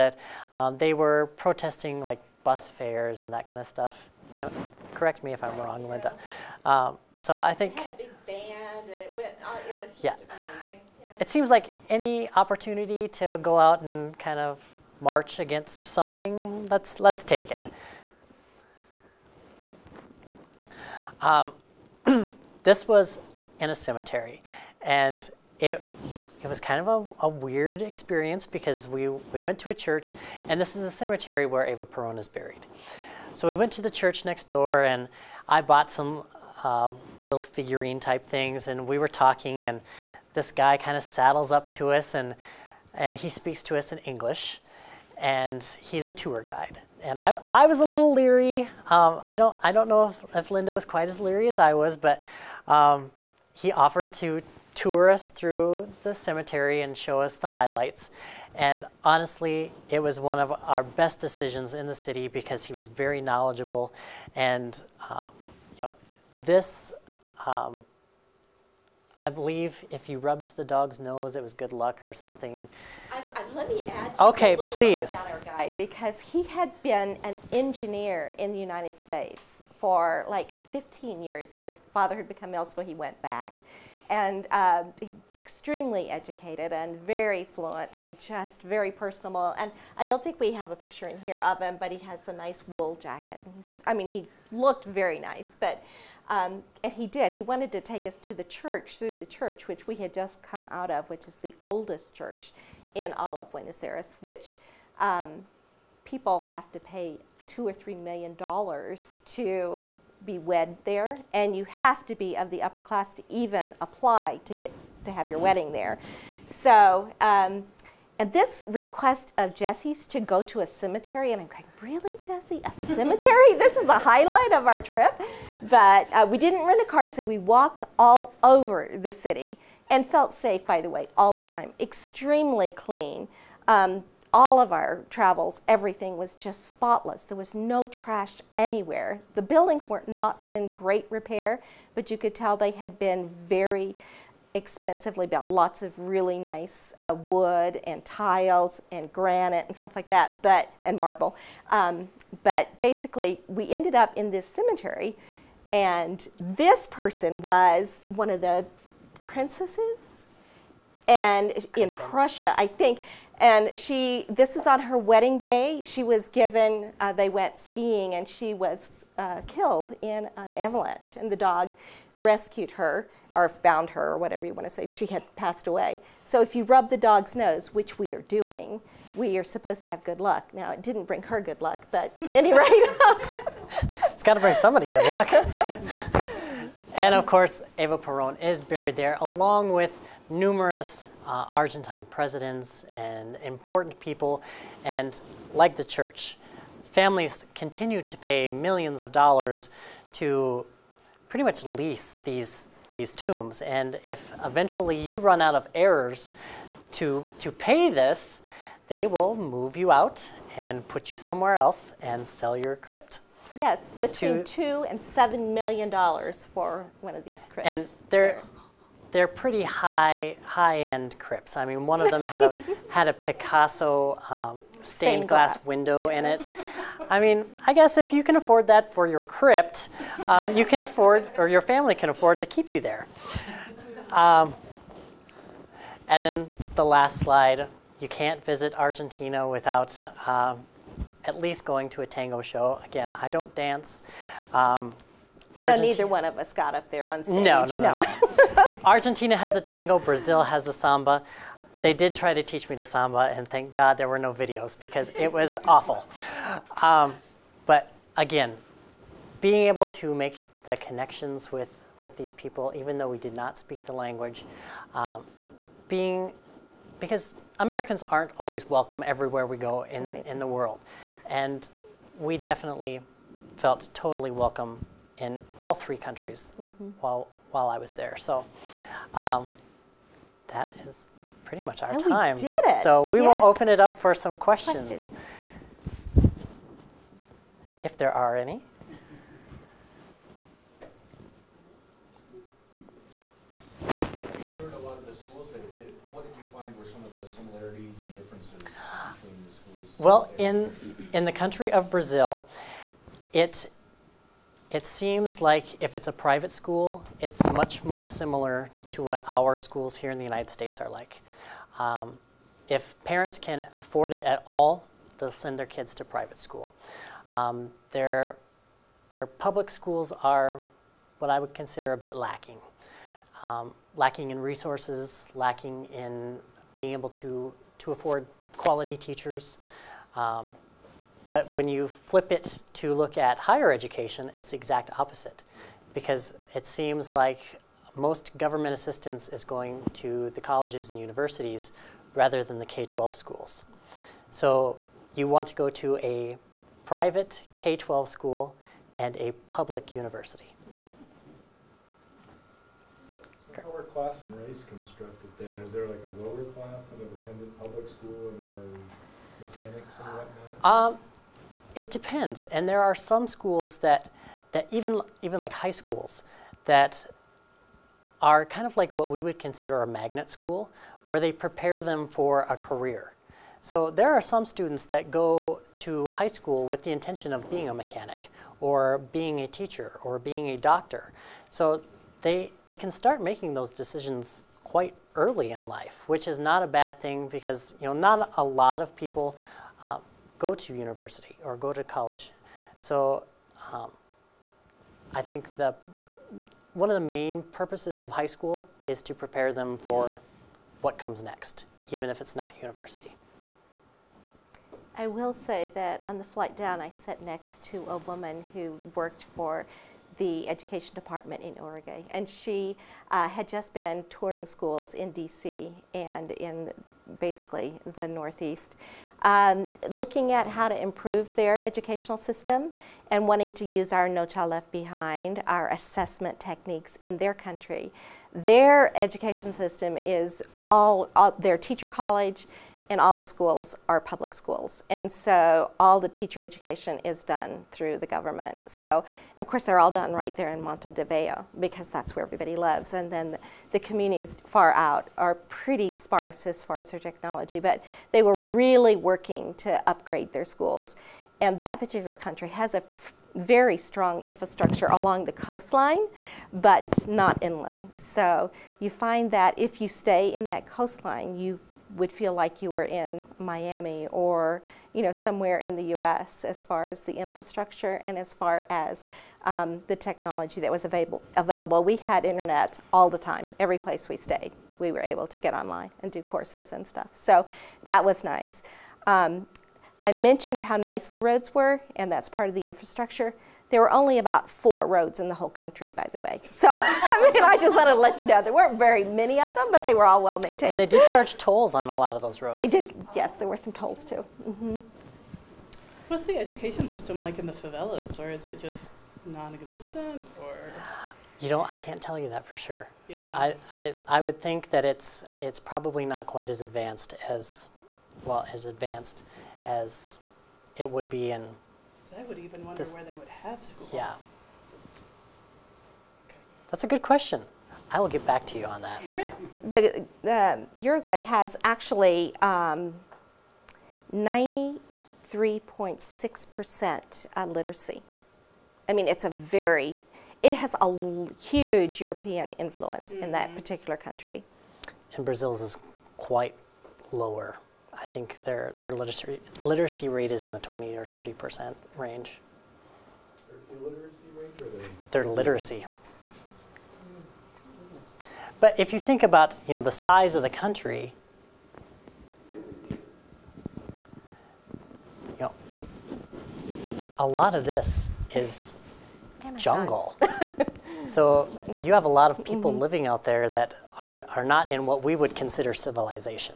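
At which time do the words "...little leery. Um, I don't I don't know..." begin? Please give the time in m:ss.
0:47.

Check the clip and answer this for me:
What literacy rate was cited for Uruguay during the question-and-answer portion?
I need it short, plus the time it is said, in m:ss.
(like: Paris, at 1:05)
93.6%, at 8:42.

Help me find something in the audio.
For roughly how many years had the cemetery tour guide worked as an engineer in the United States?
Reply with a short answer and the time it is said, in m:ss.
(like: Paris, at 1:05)
15, at 1:20.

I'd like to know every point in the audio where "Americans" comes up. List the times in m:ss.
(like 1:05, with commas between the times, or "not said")
4:27.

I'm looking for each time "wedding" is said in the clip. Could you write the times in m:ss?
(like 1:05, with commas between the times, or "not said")
1:55, 2:44.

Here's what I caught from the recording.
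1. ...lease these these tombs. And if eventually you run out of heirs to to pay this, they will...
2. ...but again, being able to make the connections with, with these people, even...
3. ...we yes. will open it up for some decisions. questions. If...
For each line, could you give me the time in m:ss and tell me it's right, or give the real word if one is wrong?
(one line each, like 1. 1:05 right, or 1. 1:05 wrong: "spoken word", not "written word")
1. 3:21 right
2. 4:17 right
3. 4:43 wrong: "questions", not "decisions".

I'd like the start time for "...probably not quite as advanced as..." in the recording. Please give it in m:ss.
8:25.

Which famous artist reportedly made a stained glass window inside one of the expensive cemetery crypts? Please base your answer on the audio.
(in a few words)
Picasso.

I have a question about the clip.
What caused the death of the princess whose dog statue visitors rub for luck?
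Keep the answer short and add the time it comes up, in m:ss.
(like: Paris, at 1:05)
an avalanche, at 2:50.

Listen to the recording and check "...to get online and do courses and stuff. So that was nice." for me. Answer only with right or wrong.
right.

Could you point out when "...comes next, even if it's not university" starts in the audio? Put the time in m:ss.
6:40.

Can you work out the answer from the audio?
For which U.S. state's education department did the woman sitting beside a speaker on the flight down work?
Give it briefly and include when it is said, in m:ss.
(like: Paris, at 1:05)
Oregon, at 6:51.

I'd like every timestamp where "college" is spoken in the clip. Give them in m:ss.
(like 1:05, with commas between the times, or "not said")
5:40, 6:31, 7:11.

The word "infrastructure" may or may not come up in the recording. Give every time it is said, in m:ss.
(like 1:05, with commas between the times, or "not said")
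7:34, 7:47, 8:02.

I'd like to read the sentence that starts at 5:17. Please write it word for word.
Um, their, their public schools are what I would consider a bit lacking.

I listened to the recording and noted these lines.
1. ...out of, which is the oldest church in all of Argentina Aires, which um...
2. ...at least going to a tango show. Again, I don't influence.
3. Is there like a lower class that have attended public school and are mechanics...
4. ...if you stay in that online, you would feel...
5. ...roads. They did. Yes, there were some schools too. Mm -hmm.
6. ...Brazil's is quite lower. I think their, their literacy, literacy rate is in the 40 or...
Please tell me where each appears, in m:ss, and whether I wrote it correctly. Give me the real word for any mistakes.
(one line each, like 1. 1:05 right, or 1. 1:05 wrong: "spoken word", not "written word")
1. 1:40 wrong: "Buenos", not "Argentina"
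2. 4:01 wrong: "dance", not "influence"
3. 5:55 right
4. 7:39 wrong: "coastline", not "online"
5. 8:12 wrong: "tolls", not "schools"
6. 8:55 wrong: "20", not "40".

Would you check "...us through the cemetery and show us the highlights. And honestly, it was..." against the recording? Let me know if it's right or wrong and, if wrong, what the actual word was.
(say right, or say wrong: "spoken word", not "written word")
right.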